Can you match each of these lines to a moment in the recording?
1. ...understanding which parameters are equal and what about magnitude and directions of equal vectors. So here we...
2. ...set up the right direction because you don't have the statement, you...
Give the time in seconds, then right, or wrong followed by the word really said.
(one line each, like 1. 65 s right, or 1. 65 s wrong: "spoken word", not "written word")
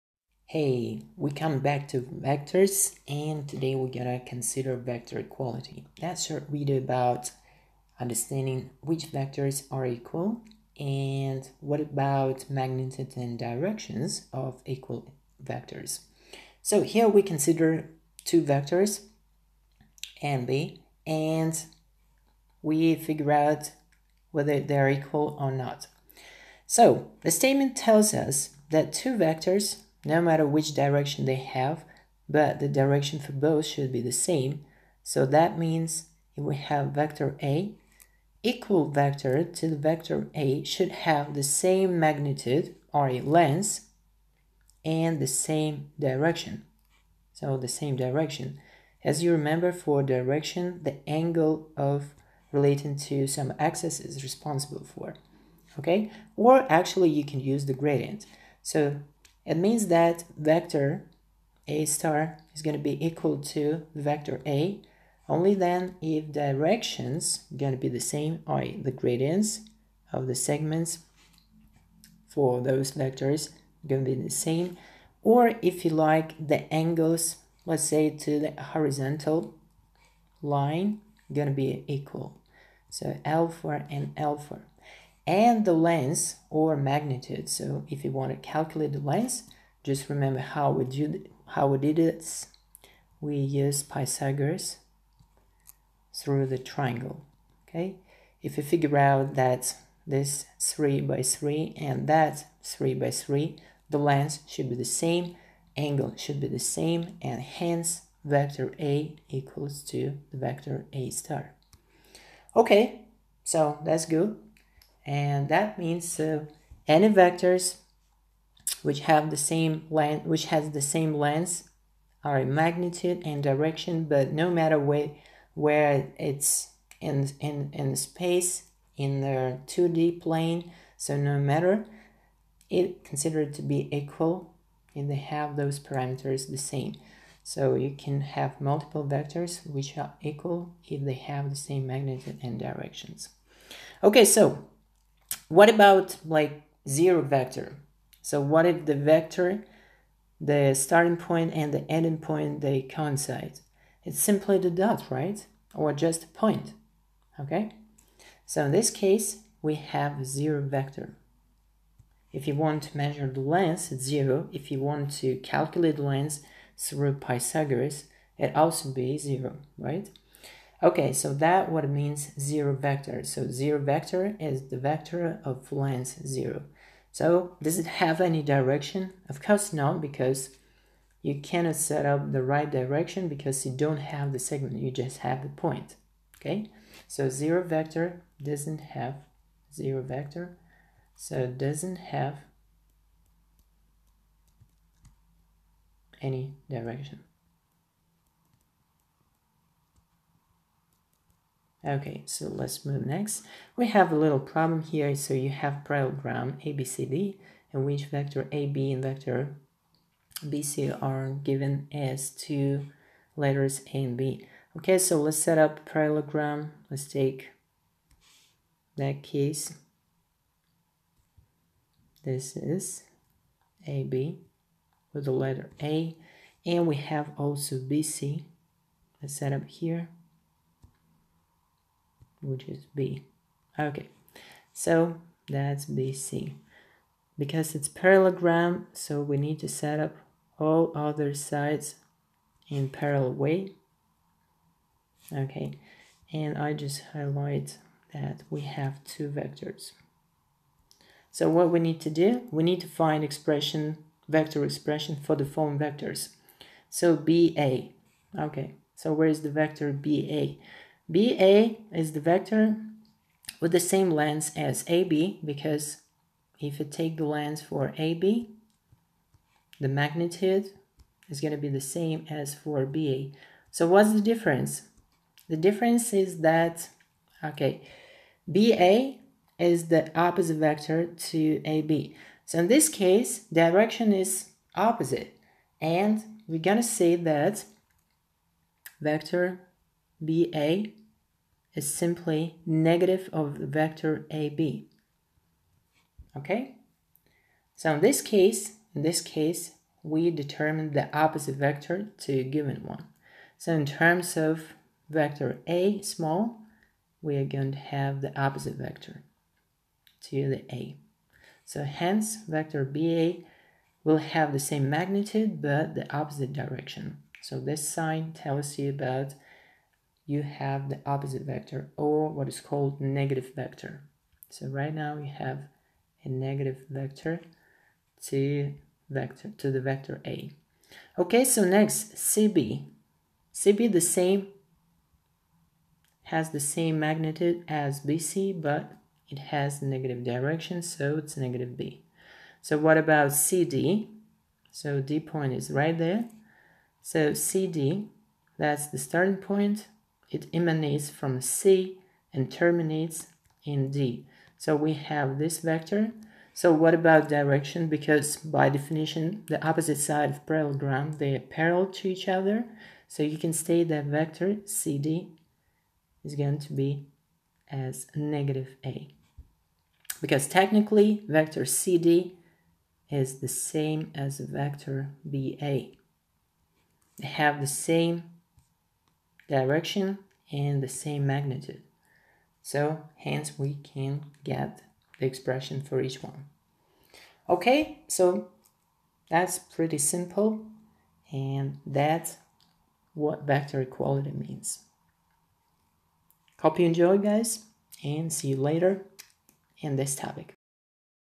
1. 8 s wrong: "vectors", not "parameters"
2. 181 s wrong: "segment", not "statement".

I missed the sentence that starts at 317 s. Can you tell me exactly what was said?
So this sign tells you about you have the opposite vector or what is called negative vector.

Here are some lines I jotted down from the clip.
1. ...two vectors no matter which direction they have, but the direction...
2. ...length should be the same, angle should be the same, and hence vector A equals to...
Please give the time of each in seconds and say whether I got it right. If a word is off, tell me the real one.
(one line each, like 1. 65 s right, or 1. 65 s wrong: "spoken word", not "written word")
1. 28 s right
2. 103 s right.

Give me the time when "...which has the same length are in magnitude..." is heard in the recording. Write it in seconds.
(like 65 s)
120 s.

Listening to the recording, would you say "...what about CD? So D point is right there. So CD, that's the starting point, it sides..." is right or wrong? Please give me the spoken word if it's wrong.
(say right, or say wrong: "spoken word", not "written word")
wrong: "emanates", not "sides".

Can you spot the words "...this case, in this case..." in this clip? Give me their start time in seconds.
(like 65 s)
298 s.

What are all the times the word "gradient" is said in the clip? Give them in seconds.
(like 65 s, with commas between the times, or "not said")
57 s, 68 s.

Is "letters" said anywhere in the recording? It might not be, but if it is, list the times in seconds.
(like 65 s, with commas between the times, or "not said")
213 s, 225 s.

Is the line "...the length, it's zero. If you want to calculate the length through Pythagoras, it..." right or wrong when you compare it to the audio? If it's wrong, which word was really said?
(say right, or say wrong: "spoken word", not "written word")
right.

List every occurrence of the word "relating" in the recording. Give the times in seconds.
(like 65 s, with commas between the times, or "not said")
52 s.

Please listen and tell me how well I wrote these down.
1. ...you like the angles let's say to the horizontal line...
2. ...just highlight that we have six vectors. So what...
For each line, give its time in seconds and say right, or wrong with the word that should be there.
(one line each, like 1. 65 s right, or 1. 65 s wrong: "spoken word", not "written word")
1. 75 s right
2. 246 s wrong: "two", not "six".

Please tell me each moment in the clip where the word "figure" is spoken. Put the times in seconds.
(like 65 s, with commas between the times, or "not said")
22 s, 98 s.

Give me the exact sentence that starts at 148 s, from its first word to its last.
So what if the vector, the starting point and the ending point, they coincide?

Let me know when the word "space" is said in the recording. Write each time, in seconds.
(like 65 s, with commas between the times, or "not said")
127 s.